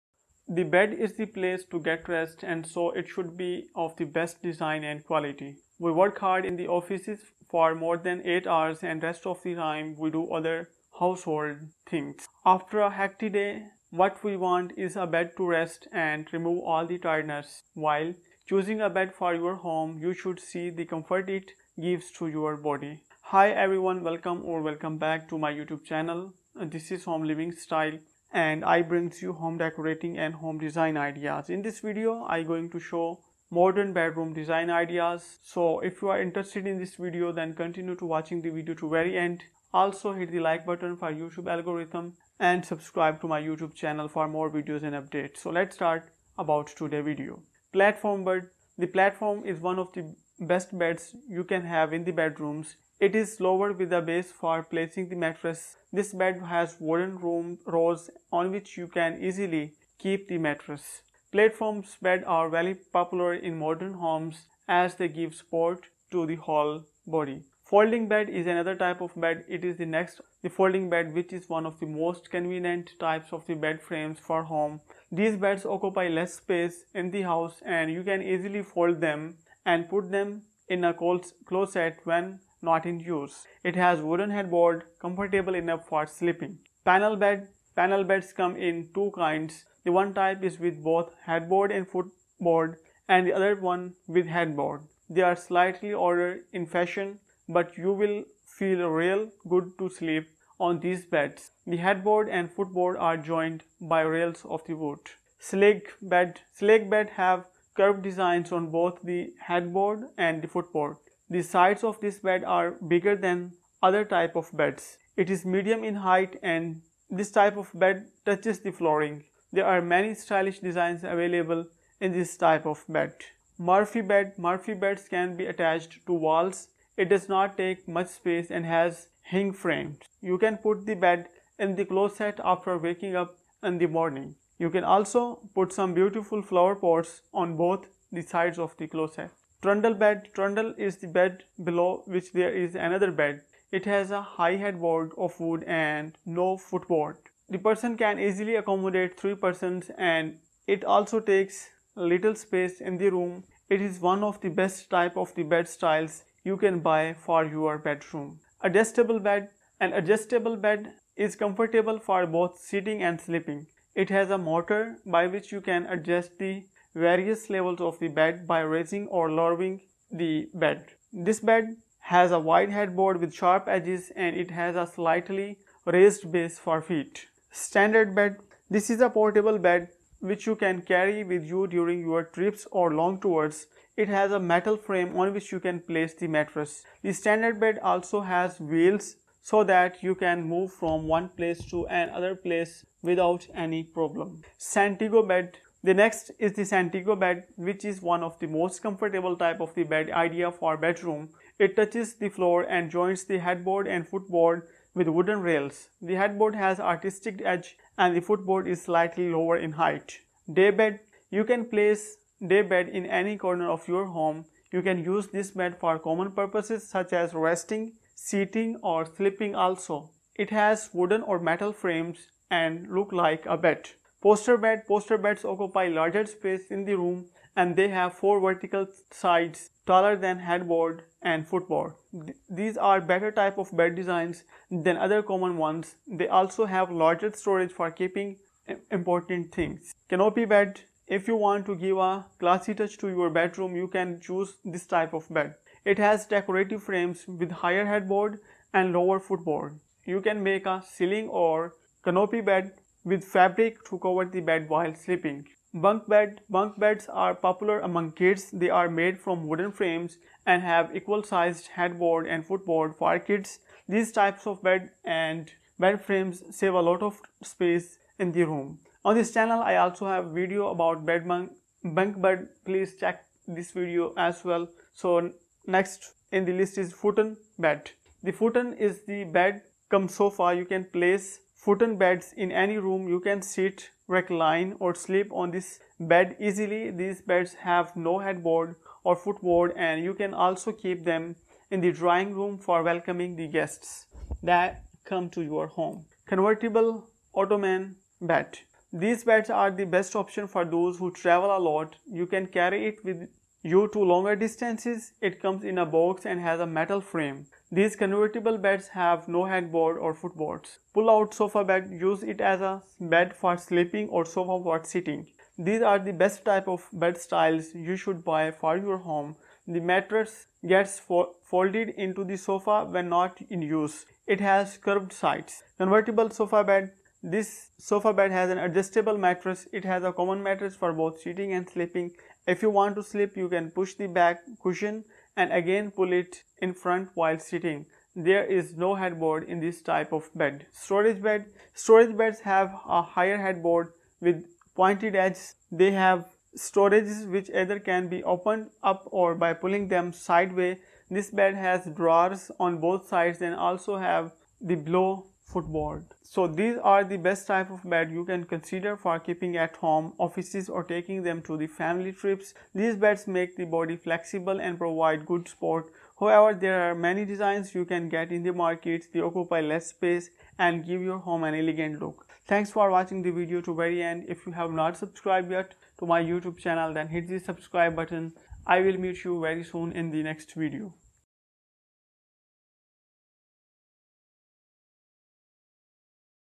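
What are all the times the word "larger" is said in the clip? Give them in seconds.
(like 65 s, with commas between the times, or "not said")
225 s, 237 s.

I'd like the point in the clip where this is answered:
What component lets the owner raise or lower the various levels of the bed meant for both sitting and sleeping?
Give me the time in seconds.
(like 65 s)
164 s.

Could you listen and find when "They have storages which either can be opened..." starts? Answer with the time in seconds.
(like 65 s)
345 s.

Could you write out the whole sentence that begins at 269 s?
On this channel I also have video about bed bunk, bunk bed.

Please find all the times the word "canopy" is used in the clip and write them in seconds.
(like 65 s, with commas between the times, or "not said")
240 s, 252 s.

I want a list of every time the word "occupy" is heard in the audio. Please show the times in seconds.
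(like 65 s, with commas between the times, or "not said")
75 s, 225 s, 369 s.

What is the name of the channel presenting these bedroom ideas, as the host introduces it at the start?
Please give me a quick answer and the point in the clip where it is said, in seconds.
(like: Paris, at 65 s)
Home Living Style, at 27 s.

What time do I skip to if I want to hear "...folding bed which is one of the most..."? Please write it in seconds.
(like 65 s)
70 s.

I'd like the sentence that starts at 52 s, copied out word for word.
It is lowered with a base for placing the mattress.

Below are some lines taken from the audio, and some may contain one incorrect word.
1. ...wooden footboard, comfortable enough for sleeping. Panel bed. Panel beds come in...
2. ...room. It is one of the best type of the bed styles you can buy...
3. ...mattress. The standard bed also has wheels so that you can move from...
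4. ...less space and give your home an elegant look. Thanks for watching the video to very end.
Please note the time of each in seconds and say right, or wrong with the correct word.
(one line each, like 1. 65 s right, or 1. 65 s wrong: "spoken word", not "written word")
1. 84 s wrong: "headboard", not "footboard"
2. 153 s right
3. 186 s right
4. 369 s right.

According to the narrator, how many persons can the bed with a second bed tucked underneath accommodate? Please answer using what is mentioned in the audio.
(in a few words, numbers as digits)
3.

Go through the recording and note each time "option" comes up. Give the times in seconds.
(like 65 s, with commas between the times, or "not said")
300 s.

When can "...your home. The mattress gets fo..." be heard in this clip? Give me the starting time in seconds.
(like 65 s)
318 s.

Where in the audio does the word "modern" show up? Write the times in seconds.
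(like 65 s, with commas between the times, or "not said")
33 s, 63 s.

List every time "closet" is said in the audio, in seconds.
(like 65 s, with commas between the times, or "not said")
80 s, 131 s, 138 s.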